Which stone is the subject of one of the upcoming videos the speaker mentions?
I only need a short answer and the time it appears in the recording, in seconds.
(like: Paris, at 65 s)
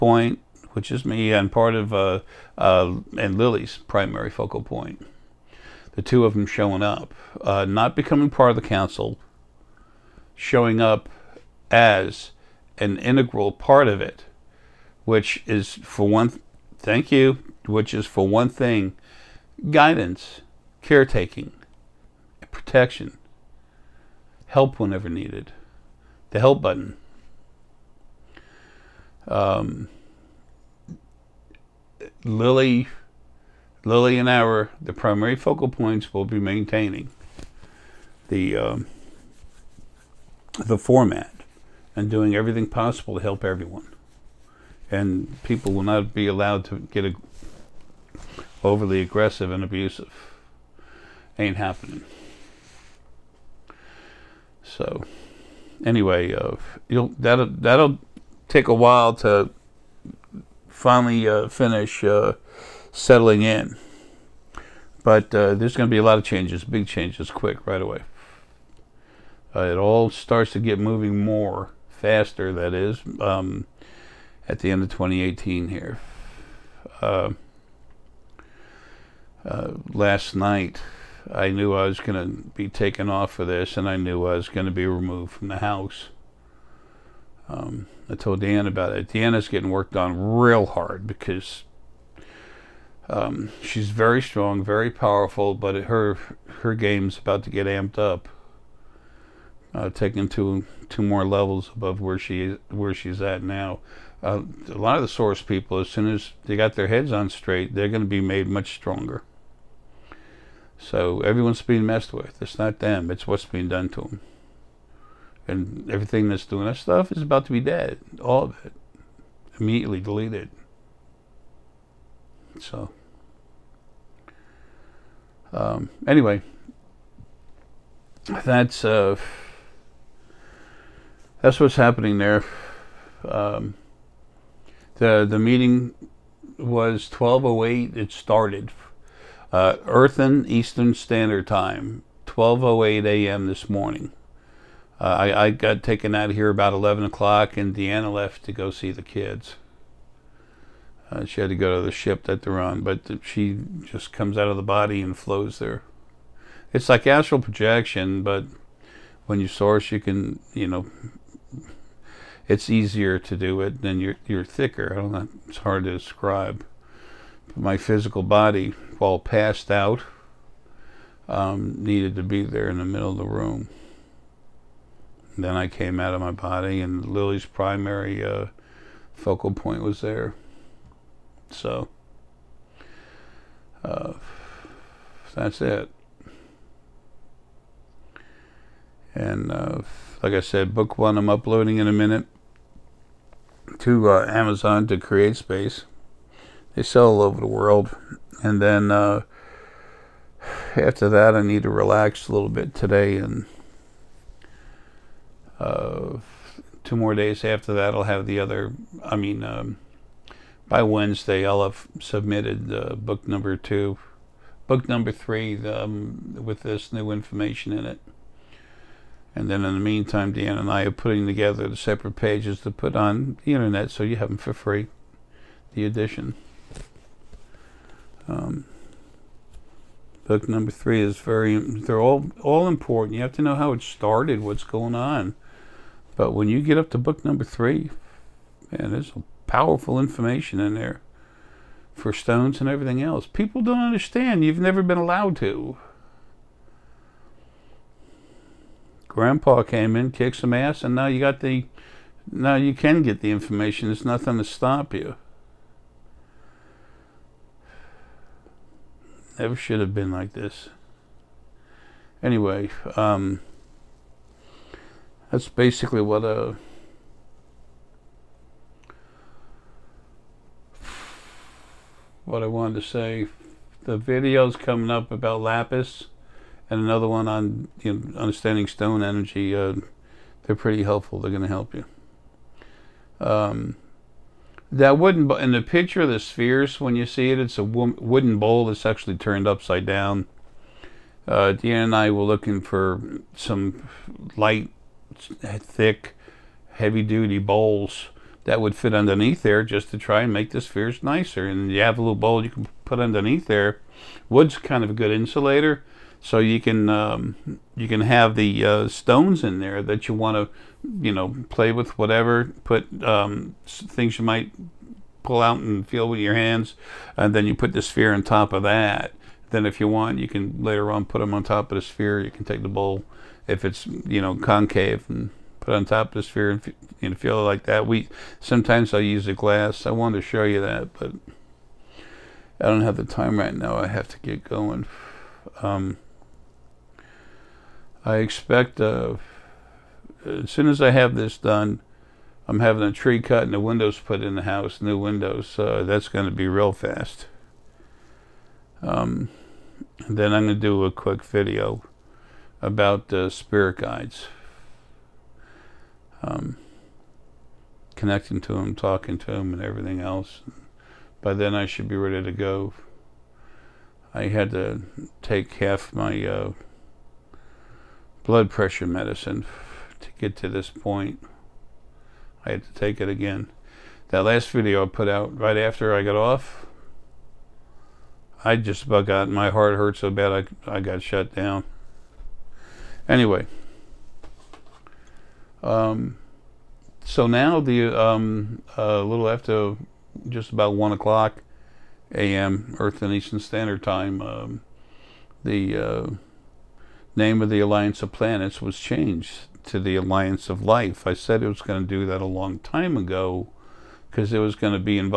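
lapis, at 275 s.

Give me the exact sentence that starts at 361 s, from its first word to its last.
By then, I should be ready to go.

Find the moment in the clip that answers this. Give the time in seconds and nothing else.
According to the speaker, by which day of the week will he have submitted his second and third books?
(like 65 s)
210 s.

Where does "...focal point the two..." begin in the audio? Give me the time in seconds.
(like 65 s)
4 s.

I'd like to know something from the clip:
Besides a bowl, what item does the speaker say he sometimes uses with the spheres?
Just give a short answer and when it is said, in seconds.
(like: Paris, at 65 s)
a glass, at 329 s.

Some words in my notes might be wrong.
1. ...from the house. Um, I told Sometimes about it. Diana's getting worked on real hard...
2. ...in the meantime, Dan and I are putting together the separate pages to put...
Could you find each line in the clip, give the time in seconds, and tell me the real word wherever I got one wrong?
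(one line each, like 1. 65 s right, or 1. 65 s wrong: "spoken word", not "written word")
1. 85 s wrong: "Dan", not "Sometimes"
2. 219 s right.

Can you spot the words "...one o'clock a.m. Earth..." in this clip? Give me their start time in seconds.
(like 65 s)
390 s.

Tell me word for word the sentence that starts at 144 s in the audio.
Uh, I, I got taken out of here about 11 o'clock, and Diana left to go see the kids.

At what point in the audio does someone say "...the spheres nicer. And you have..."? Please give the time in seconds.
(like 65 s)
300 s.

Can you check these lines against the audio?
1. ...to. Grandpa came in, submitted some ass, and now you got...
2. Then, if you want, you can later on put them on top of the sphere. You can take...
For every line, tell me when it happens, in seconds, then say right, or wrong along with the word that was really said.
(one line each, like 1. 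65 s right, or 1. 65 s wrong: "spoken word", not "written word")
1. 245 s wrong: "kicked", not "submitted"
2. 319 s right.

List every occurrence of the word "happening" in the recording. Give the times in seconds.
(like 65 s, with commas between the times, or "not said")
51 s, 131 s.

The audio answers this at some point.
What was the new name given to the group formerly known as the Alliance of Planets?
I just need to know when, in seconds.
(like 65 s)
399 s.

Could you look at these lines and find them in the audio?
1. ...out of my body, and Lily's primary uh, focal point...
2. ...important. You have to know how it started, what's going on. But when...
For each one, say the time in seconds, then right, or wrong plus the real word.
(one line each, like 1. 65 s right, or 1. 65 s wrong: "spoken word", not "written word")
1. 175 s right
2. 232 s right.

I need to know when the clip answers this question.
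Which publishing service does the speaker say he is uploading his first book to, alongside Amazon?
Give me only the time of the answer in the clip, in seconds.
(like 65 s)
194 s.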